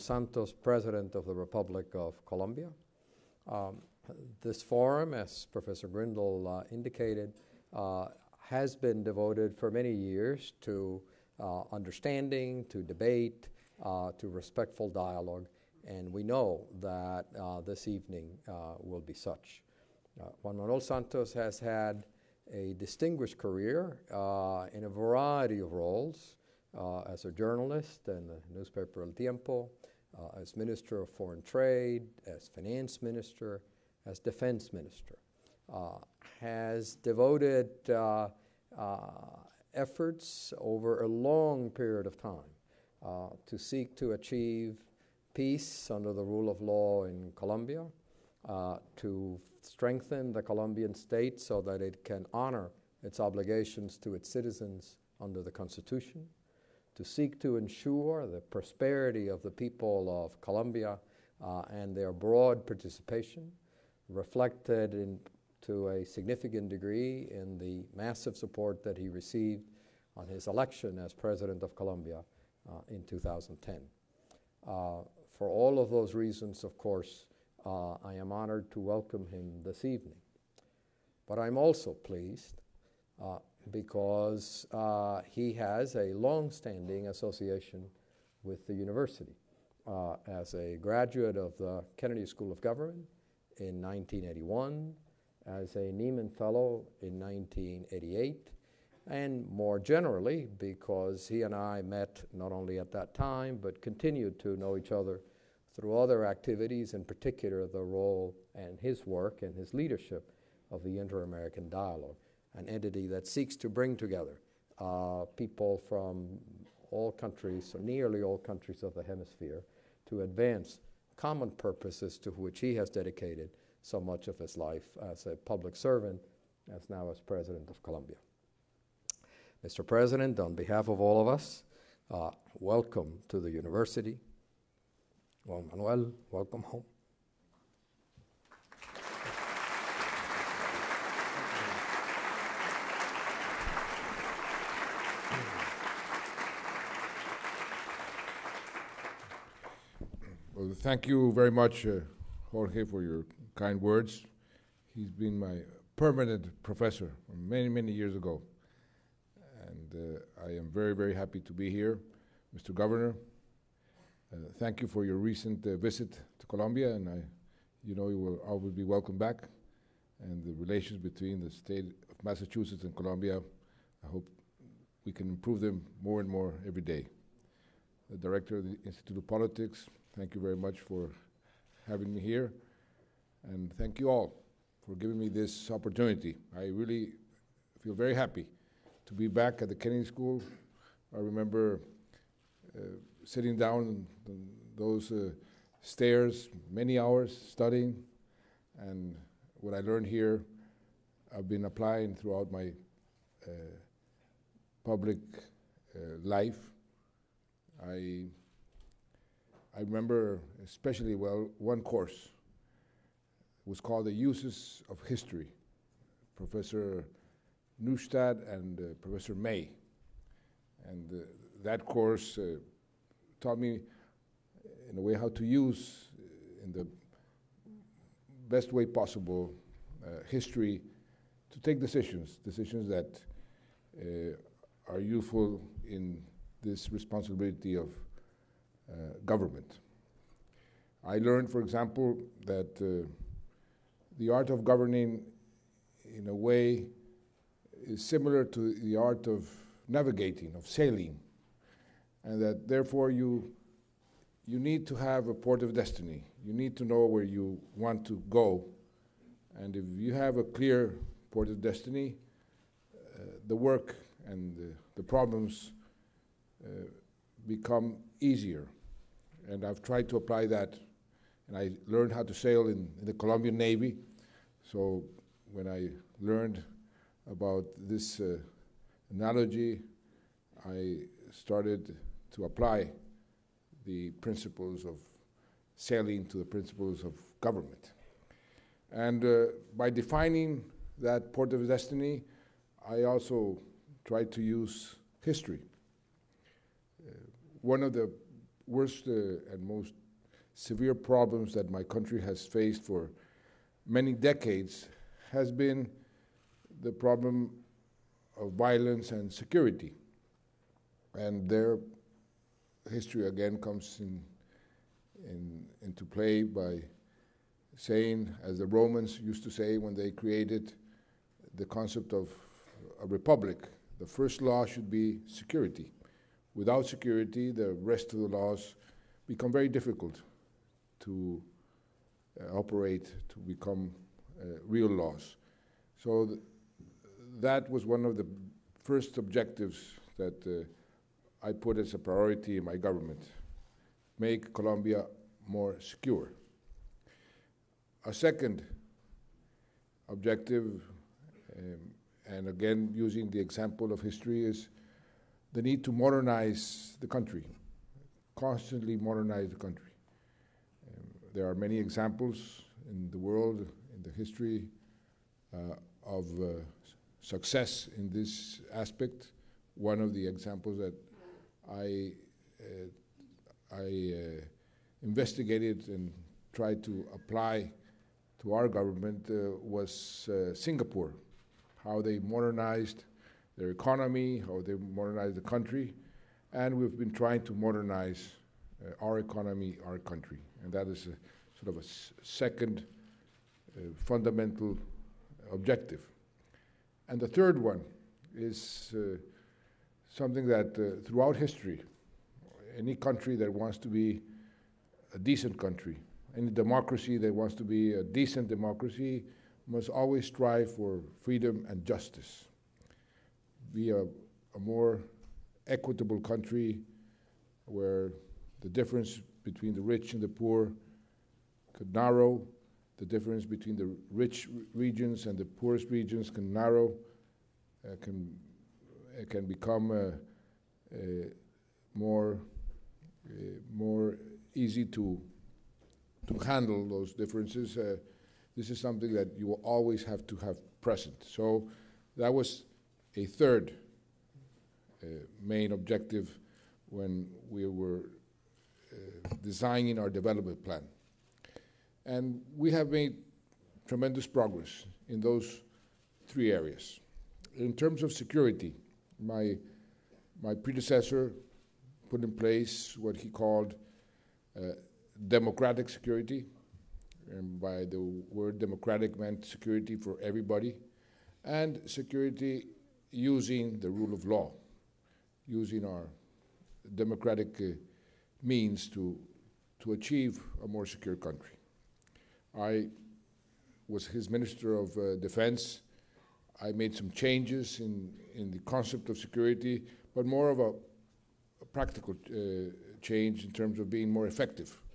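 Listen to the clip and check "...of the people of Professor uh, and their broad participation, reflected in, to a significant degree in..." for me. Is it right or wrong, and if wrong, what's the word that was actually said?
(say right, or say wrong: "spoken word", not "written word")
wrong: "Colombia", not "Professor".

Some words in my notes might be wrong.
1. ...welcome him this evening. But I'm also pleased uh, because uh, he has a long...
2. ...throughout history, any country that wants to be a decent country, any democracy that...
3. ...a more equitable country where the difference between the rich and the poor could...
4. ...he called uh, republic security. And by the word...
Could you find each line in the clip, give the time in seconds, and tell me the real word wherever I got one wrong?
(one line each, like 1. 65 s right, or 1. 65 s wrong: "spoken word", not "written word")
1. 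78 s right
2. 401 s right
3. 414 s right
4. 463 s wrong: "democratic", not "republic".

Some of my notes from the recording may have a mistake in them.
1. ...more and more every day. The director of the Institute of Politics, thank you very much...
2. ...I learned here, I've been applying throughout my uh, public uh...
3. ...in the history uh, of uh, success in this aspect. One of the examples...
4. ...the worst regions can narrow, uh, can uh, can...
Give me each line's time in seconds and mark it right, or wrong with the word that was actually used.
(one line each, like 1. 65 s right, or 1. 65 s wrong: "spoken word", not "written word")
1. 176 s right
2. 199 s right
3. 363 s right
4. 425 s wrong: "poorest", not "worst".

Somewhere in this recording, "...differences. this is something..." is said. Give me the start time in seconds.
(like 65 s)
437 s.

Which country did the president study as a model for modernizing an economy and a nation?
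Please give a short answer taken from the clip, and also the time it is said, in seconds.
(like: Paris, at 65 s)
Singapore, at 380 s.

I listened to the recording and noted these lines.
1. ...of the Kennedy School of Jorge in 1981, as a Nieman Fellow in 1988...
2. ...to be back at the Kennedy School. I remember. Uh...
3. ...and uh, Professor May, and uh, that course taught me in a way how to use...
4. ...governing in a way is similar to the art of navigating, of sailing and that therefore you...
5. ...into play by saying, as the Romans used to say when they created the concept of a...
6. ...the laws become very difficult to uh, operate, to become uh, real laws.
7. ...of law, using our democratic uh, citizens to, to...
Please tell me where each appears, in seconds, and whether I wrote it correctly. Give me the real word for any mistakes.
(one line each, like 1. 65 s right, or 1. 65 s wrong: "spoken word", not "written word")
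1. 91 s wrong: "Government", not "Jorge"
2. 189 s right
3. 218 s right
4. 244 s right
5. 315 s right
6. 328 s right
7. 474 s wrong: "means", not "citizens".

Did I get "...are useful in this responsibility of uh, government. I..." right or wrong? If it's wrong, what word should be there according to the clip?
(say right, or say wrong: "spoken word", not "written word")
right.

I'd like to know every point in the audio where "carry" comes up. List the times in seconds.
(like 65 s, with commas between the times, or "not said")
not said.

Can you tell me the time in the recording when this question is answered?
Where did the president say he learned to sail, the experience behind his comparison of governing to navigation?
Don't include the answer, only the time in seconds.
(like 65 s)
273 s.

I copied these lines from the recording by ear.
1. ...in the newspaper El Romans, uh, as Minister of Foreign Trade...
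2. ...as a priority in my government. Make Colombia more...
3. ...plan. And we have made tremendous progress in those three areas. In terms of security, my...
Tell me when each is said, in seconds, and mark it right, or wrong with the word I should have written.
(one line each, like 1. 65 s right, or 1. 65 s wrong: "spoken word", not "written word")
1. 28 s wrong: "Tiempo", not "Romans"
2. 341 s right
3. 450 s right.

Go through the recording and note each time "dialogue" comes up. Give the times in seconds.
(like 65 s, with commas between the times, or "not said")
14 s, 111 s.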